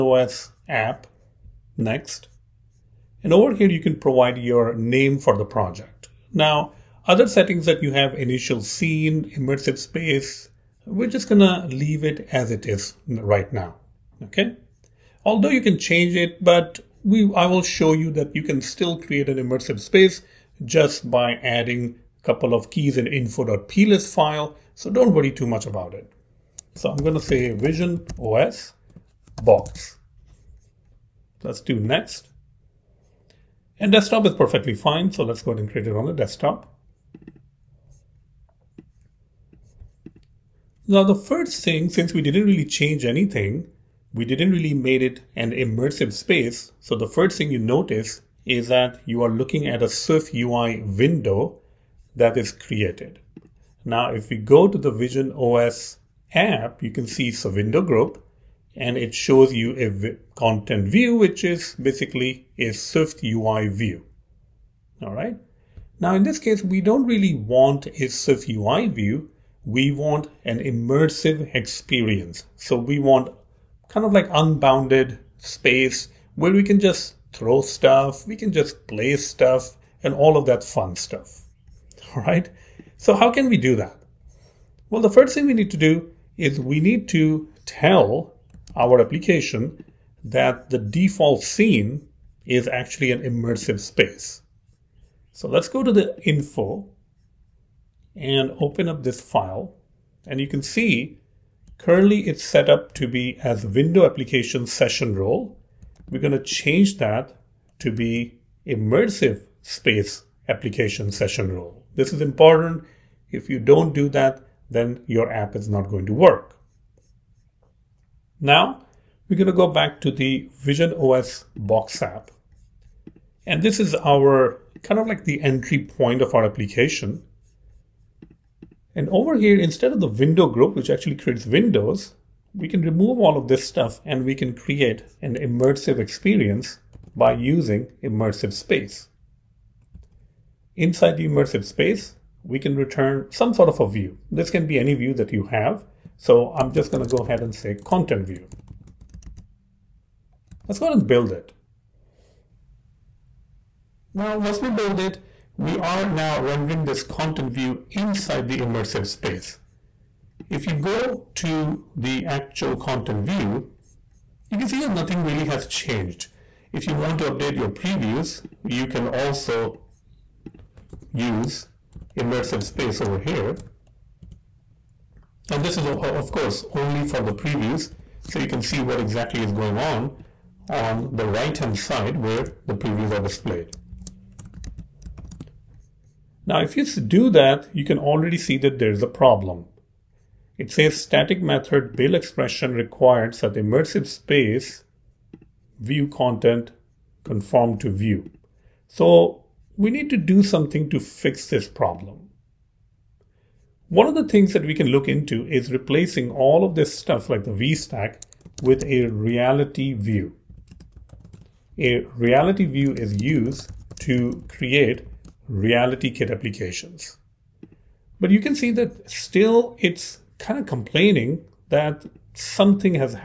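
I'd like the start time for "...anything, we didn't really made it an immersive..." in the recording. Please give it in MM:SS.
00:43.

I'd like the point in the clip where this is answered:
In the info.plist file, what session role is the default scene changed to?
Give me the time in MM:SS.
01:48.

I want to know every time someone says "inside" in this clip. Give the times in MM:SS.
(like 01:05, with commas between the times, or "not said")
02:20, 02:37.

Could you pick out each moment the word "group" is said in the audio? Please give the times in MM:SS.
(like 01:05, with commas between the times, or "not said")
00:57, 02:10.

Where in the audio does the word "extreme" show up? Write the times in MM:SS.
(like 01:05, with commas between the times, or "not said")
not said.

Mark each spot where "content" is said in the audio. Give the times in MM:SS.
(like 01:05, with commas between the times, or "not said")
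01:00, 02:27, 02:37, 02:42, 03:16.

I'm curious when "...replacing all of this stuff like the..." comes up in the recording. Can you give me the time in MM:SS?
03:25.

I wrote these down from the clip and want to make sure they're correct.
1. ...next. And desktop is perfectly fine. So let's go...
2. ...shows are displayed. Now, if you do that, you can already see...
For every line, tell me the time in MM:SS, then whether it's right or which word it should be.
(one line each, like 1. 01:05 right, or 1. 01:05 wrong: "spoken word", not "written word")
1. 00:31 right
2. 03:02 wrong: "previews", not "shows".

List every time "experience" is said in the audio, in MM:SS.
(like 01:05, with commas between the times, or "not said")
01:11, 02:15.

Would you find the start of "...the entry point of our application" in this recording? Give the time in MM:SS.
02:05.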